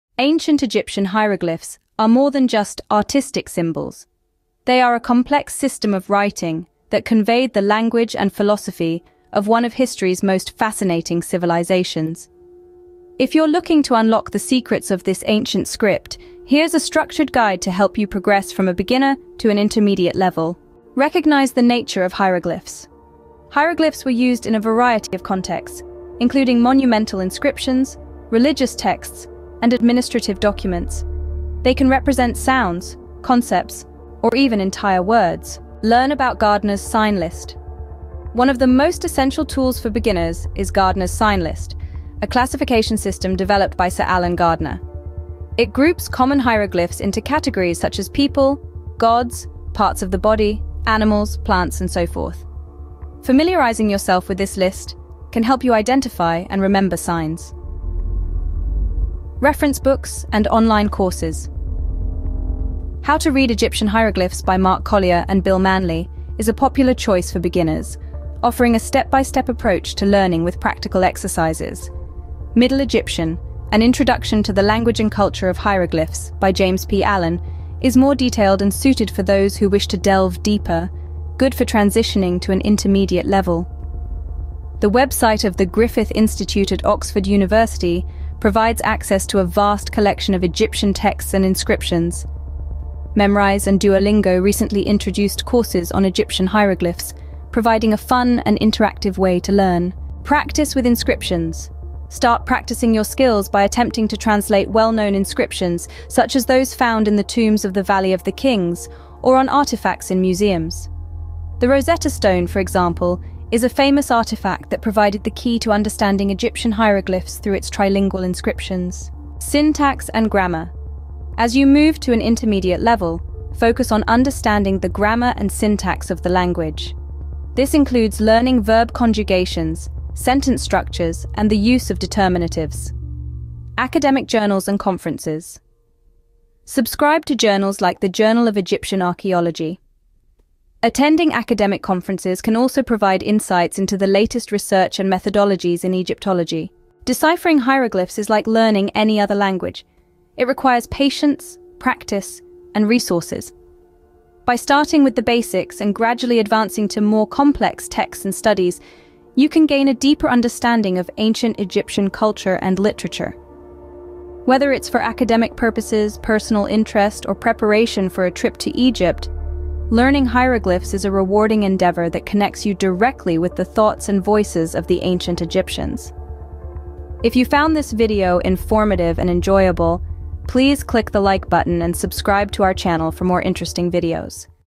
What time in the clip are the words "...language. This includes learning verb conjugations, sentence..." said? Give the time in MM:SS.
02:06.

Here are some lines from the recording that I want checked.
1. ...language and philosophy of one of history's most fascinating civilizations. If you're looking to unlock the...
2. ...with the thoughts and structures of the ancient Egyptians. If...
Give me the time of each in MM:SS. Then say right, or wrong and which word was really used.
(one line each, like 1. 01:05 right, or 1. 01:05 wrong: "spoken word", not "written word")
1. 00:07 right
2. 02:53 wrong: "voices", not "structures".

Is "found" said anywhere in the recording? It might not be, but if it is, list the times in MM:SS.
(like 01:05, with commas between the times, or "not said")
01:46, 02:57.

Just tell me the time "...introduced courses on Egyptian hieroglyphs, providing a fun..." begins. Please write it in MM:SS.
01:34.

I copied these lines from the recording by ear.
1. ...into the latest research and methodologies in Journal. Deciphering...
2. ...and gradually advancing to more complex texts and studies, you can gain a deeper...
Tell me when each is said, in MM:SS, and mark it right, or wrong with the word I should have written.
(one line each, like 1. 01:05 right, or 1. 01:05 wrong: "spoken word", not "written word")
1. 02:23 wrong: "Egyptology", not "Journal"
2. 02:35 right.